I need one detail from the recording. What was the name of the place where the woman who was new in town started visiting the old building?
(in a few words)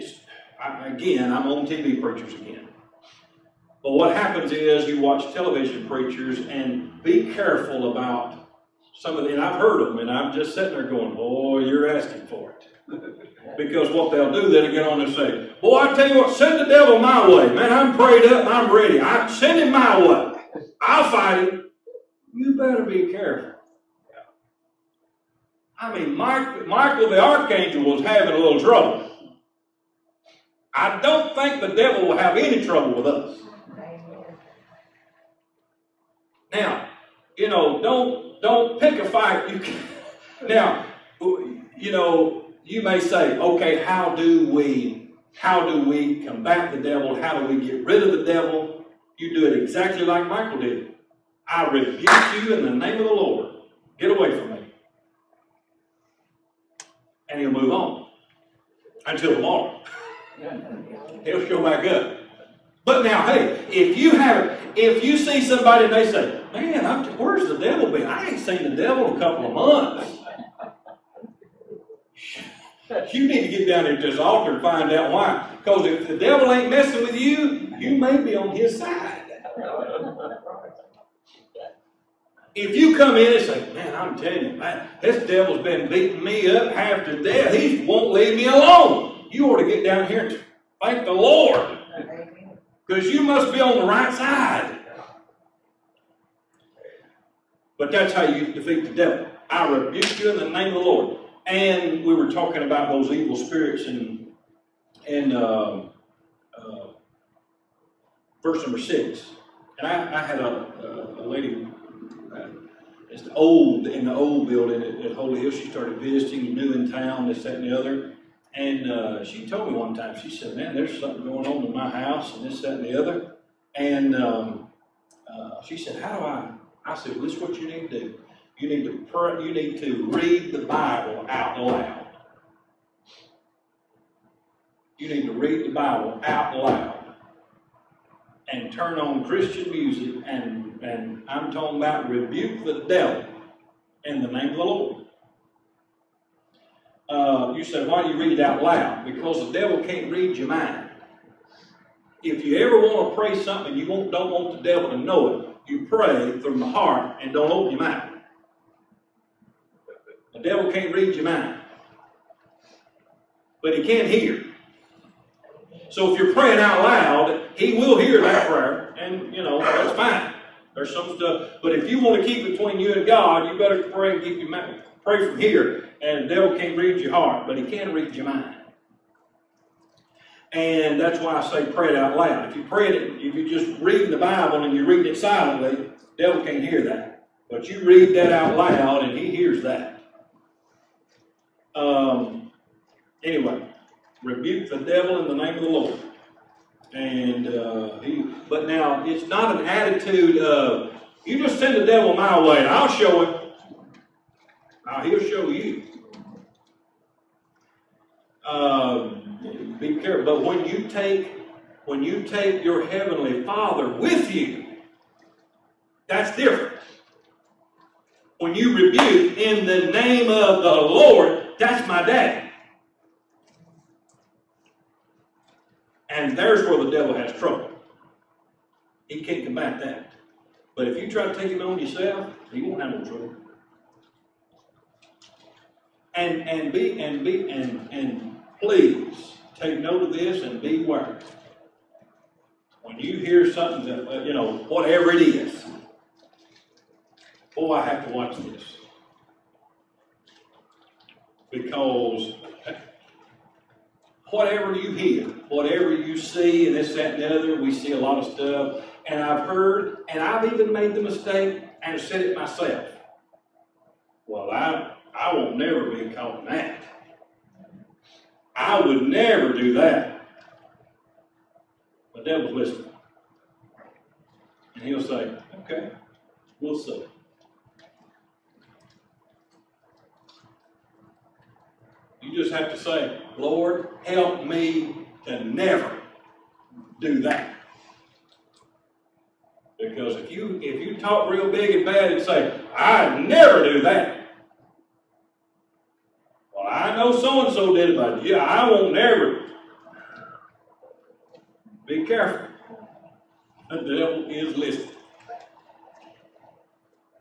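Holy Hill.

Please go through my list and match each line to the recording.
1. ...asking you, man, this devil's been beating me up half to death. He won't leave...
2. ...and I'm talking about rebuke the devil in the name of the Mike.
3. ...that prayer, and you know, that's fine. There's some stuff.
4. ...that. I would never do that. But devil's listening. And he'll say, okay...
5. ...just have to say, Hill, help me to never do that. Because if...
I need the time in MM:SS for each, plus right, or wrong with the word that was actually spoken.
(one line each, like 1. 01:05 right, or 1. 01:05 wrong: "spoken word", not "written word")
1. 01:24 wrong: "telling", not "asking"
2. 02:20 wrong: "Lord", not "Mike"
3. 02:48 right
4. 04:26 right
5. 04:42 wrong: "Lord", not "Hill".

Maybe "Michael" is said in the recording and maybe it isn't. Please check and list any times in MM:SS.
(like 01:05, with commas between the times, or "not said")
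00:26, 00:50.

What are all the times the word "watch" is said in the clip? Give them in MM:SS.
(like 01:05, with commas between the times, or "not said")
00:04, 04:08.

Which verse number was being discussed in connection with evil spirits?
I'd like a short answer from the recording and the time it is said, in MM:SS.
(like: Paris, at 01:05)
6, at 01:48.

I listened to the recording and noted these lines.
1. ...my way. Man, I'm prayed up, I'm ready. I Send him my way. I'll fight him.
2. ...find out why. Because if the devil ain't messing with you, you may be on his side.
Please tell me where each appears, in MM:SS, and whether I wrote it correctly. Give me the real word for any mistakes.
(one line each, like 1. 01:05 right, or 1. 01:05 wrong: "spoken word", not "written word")
1. 00:16 right
2. 01:14 right.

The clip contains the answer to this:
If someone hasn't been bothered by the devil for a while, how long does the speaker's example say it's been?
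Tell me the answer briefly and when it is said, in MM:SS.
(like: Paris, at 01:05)
A couple of months, at 01:09.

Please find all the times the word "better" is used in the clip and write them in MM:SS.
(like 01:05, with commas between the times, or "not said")
00:22, 02:53.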